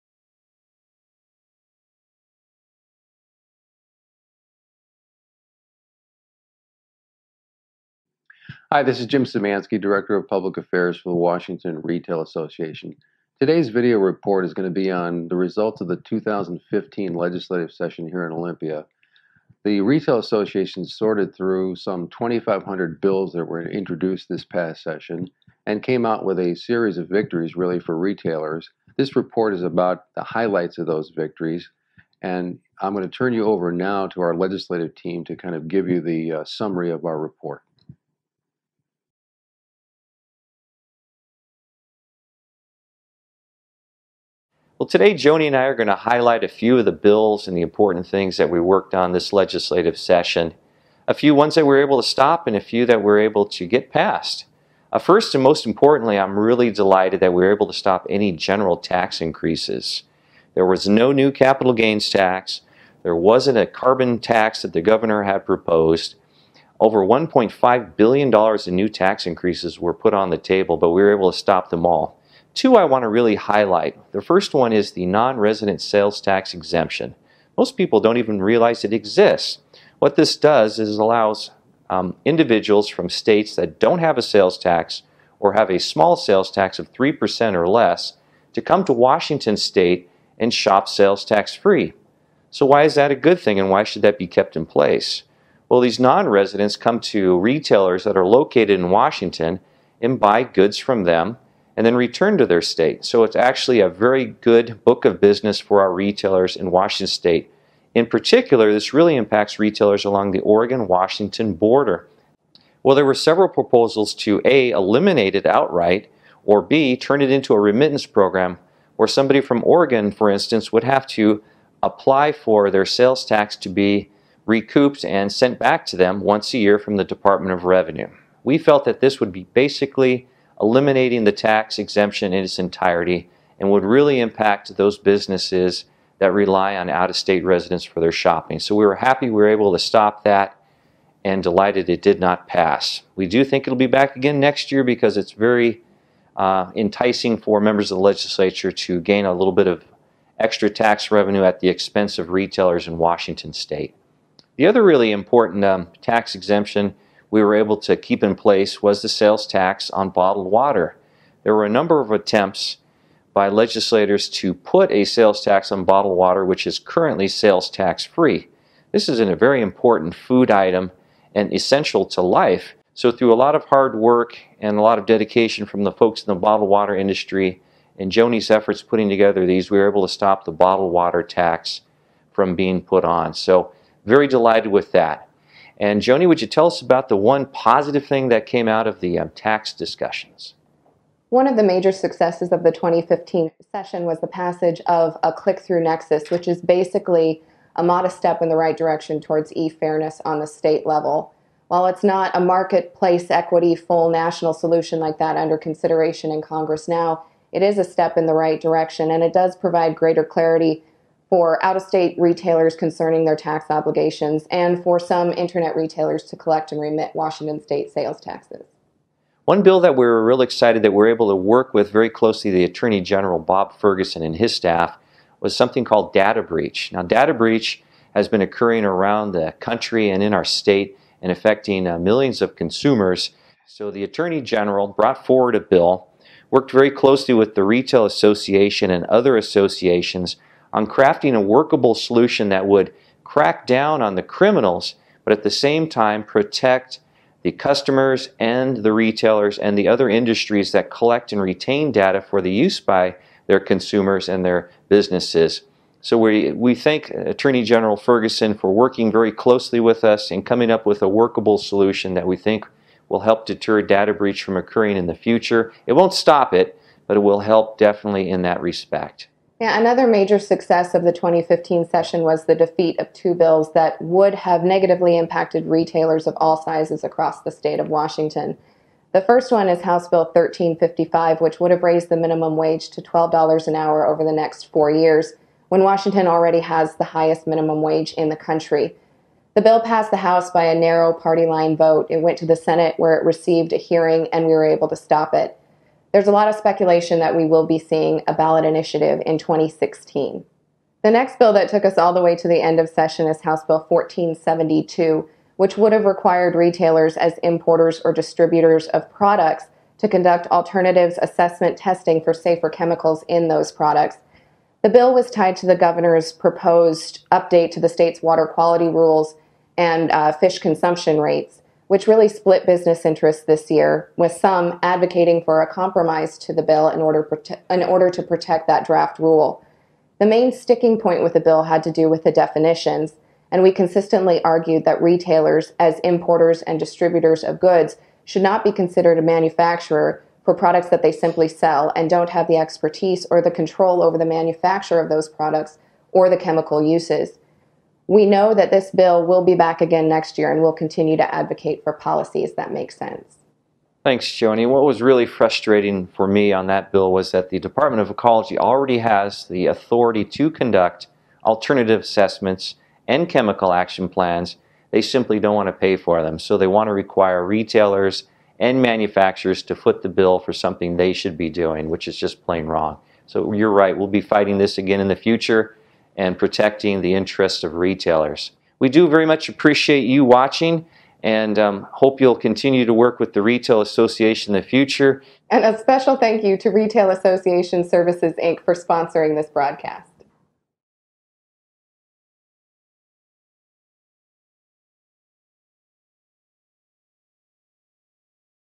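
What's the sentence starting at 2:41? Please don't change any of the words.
There were a number of attempts by legislators to put a sales tax on bottled water, which is currently sales tax free.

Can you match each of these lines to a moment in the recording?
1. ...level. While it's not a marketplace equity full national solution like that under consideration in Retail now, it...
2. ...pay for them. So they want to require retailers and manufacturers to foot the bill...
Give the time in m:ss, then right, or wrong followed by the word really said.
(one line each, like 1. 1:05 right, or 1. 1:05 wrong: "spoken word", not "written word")
1. 3:20 wrong: "Congress", not "Retail"
2. 6:05 right.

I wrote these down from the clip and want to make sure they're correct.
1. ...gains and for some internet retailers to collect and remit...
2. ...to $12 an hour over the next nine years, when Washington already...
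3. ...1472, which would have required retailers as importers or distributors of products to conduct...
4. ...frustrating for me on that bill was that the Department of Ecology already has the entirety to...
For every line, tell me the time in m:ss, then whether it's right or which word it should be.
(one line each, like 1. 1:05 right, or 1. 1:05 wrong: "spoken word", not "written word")
1. 3:33 wrong: "obligations", not "gains"
2. 4:42 wrong: "four", not "nine"
3. 5:03 right
4. 5:55 wrong: "authority", not "entirety".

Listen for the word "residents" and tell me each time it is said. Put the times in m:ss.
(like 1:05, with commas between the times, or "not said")
1:15, 1:36, 2:17.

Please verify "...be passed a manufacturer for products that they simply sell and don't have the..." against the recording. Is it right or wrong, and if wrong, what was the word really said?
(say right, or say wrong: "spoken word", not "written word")
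wrong: "considered", not "passed".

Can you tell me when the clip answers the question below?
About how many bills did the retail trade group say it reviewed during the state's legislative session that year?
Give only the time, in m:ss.
0:22.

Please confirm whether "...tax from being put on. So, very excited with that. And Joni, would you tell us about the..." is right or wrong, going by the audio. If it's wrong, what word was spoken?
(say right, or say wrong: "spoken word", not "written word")
wrong: "delighted", not "excited".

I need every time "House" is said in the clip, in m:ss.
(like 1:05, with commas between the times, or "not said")
4:39, 4:50, 5:03.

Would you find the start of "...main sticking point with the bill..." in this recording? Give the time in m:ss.
5:30.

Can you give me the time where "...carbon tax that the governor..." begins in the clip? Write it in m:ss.
1:03.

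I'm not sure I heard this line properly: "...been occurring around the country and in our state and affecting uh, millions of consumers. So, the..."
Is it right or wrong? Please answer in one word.
right.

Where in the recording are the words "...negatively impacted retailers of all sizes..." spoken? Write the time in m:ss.
4:34.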